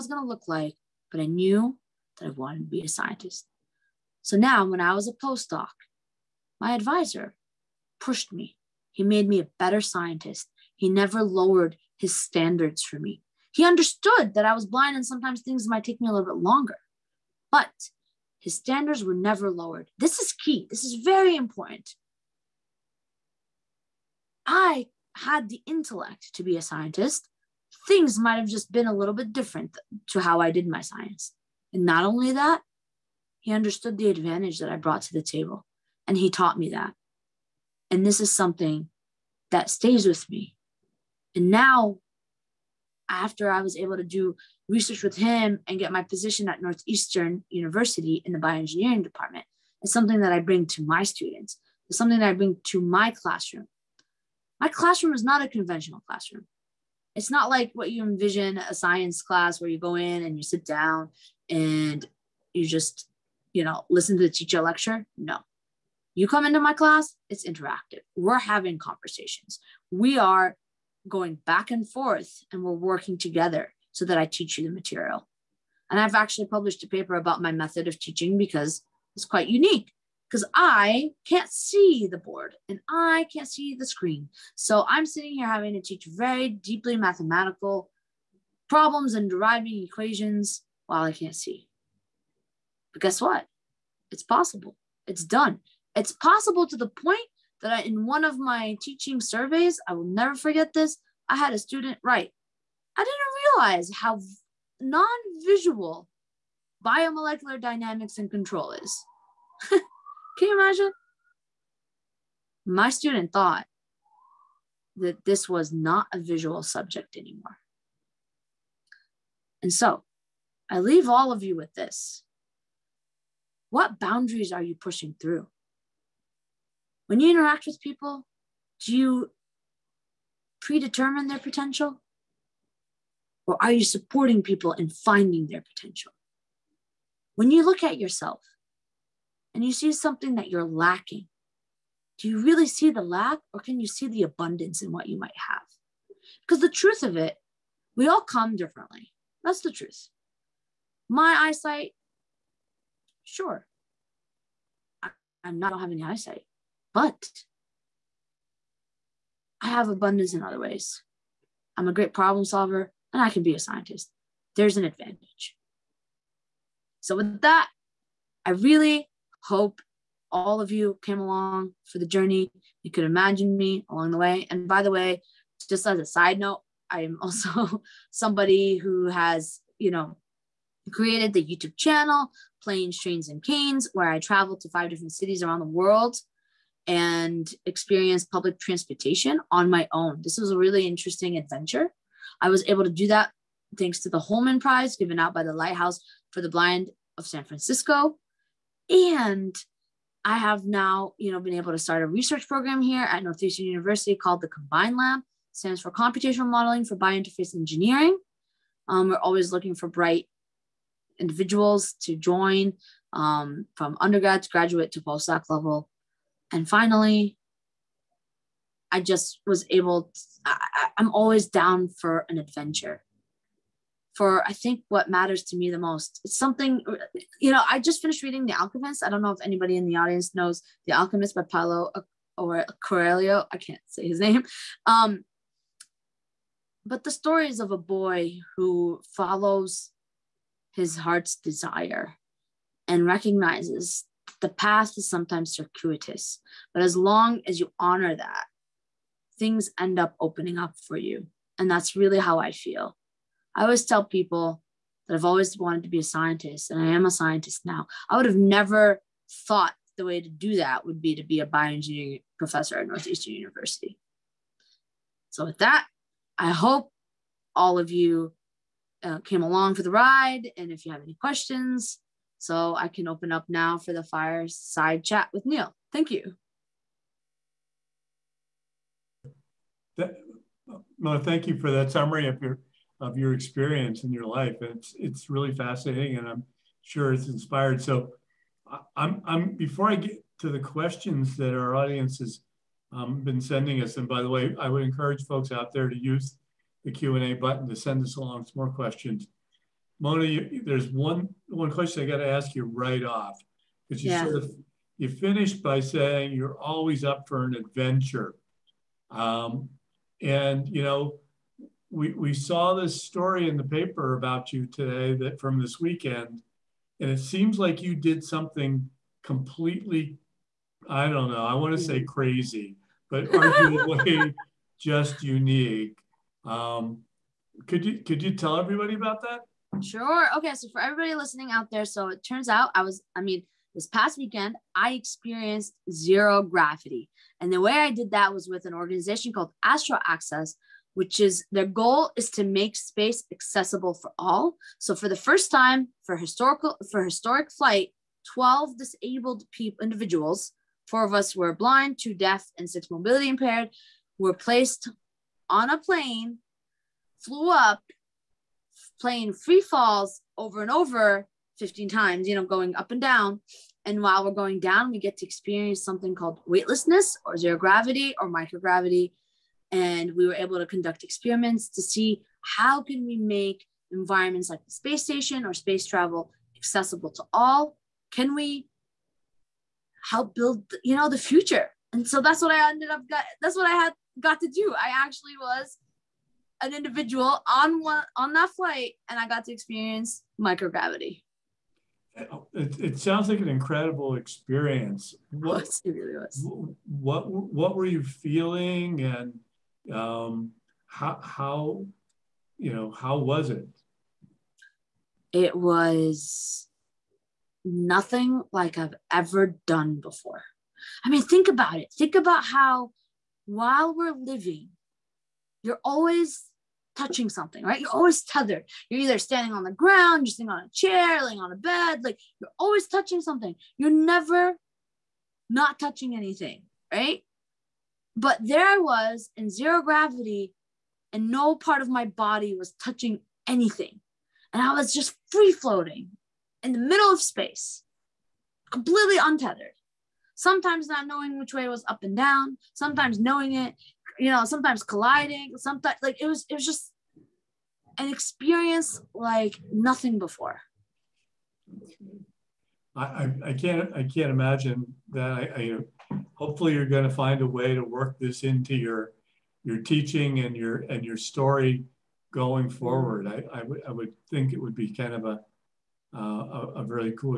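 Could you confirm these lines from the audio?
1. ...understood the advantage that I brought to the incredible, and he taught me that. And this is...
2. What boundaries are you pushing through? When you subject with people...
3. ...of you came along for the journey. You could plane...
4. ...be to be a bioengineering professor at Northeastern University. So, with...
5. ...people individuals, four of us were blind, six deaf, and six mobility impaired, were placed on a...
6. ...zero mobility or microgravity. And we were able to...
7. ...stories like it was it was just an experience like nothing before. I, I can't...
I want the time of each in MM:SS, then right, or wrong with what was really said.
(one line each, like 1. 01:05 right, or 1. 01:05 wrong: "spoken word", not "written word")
1. 00:33 wrong: "table", not "incredible"
2. 02:03 wrong: "interact", not "subject"
3. 02:50 wrong: "imagine", not "plane"
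4. 04:21 right
5. 05:49 wrong: "two", not "six"
6. 06:07 wrong: "gravity", not "mobility"
7. 07:25 wrong: "sometimes", not "stories".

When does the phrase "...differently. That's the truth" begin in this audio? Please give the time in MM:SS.
02:28.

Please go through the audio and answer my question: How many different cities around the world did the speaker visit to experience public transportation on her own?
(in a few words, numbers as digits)
5.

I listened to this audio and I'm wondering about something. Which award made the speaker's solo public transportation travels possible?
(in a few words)
Holman Prize.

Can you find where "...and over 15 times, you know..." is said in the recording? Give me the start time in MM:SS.
06:00.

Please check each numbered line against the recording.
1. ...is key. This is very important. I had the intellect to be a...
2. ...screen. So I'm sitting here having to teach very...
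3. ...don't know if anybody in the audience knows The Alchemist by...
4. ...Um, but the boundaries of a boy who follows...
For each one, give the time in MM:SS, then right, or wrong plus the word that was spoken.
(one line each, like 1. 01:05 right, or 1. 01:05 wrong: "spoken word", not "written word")
1. 00:20 right
2. 01:23 right
3. 03:49 right
4. 03:54 wrong: "stories", not "boundaries".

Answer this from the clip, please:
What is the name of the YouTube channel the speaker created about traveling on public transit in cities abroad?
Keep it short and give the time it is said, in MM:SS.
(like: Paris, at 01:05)
Planes, Trains, and Canes, at 03:02.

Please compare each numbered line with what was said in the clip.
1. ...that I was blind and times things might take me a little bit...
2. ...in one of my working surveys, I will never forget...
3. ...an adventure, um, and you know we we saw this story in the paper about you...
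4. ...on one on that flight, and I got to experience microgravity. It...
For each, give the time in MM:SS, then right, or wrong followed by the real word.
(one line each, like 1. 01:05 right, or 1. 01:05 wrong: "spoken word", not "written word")
1. 00:14 wrong: "sometimes", not "times"
2. 01:37 wrong: "teaching", not "working"
3. 05:07 right
4. 06:27 right.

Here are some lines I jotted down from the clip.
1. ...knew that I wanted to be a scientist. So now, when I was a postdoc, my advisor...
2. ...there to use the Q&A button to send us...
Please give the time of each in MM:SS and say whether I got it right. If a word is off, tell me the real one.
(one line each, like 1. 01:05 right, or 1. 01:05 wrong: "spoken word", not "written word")
1. 00:01 right
2. 04:55 right.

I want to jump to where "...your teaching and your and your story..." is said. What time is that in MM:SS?
07:39.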